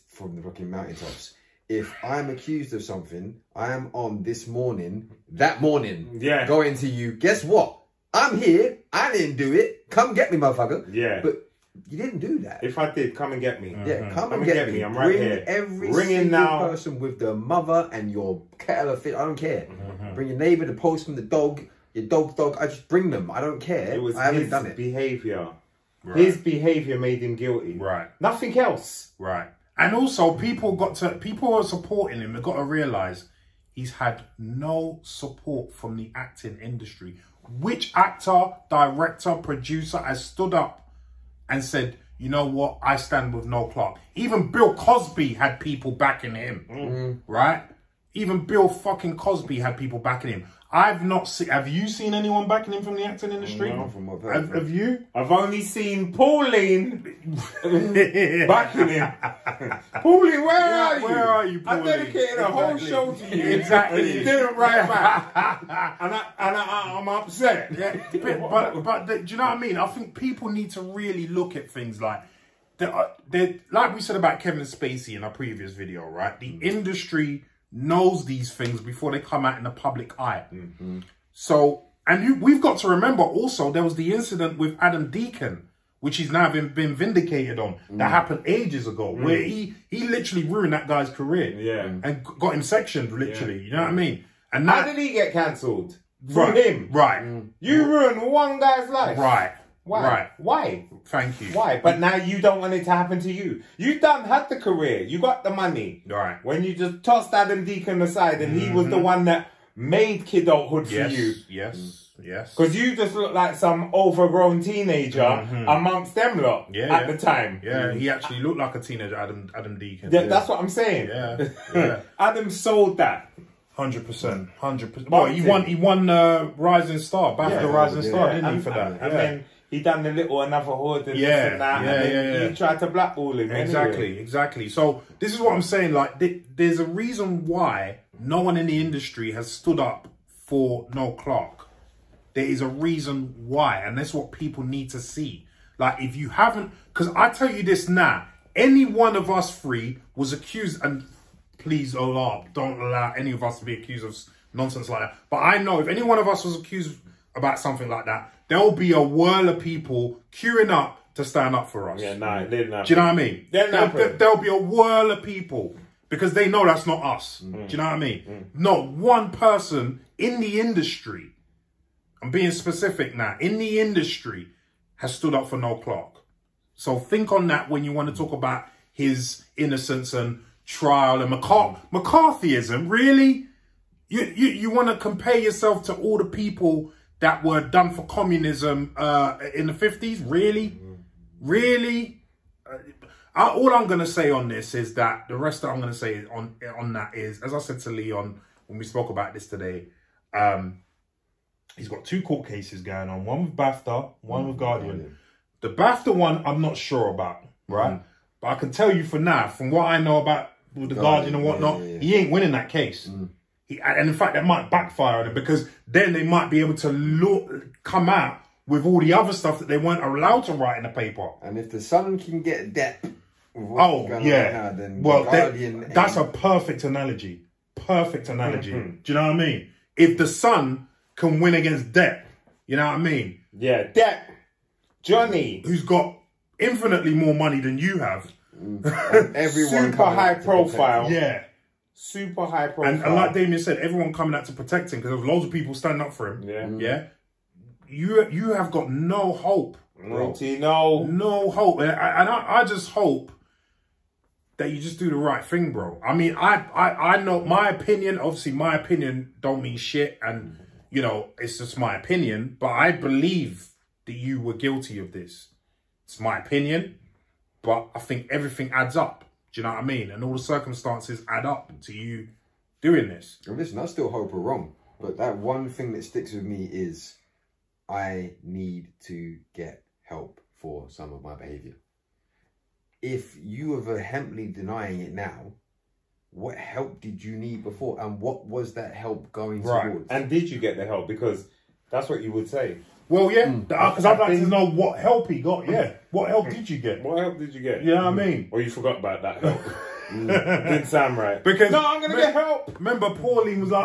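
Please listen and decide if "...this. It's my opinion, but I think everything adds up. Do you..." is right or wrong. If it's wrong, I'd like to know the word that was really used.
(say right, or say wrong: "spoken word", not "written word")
right.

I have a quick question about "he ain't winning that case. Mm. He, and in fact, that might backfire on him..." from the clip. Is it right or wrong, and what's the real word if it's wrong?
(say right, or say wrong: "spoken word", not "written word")
right.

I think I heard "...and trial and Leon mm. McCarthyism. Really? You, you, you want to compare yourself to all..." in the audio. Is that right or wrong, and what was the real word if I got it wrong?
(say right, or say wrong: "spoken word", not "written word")
wrong: "McCar", not "Leon".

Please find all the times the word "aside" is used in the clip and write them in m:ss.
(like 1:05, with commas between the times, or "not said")
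1:48.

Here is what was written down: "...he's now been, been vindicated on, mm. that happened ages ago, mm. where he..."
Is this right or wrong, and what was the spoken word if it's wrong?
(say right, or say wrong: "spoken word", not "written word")
right.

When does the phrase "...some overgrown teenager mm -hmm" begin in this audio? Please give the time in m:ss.
1:53.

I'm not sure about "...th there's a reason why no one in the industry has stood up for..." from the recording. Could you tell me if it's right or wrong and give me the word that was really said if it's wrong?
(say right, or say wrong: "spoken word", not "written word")
right.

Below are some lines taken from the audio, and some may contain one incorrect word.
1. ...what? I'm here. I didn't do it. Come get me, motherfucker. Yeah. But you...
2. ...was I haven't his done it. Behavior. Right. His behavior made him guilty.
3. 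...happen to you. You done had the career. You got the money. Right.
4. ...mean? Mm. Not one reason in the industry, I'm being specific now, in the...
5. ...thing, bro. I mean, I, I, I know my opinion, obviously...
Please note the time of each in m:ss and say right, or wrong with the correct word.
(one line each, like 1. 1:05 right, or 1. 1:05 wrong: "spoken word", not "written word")
1. 0:07 right
2. 0:24 right
3. 1:42 right
4. 2:47 wrong: "person", not "reason"
5. 4:15 right.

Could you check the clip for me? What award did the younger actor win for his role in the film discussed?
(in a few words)
Rising Star.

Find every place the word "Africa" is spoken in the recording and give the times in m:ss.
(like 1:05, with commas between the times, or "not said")
not said.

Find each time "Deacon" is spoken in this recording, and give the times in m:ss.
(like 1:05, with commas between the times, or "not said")
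1:25, 1:47, 1:59.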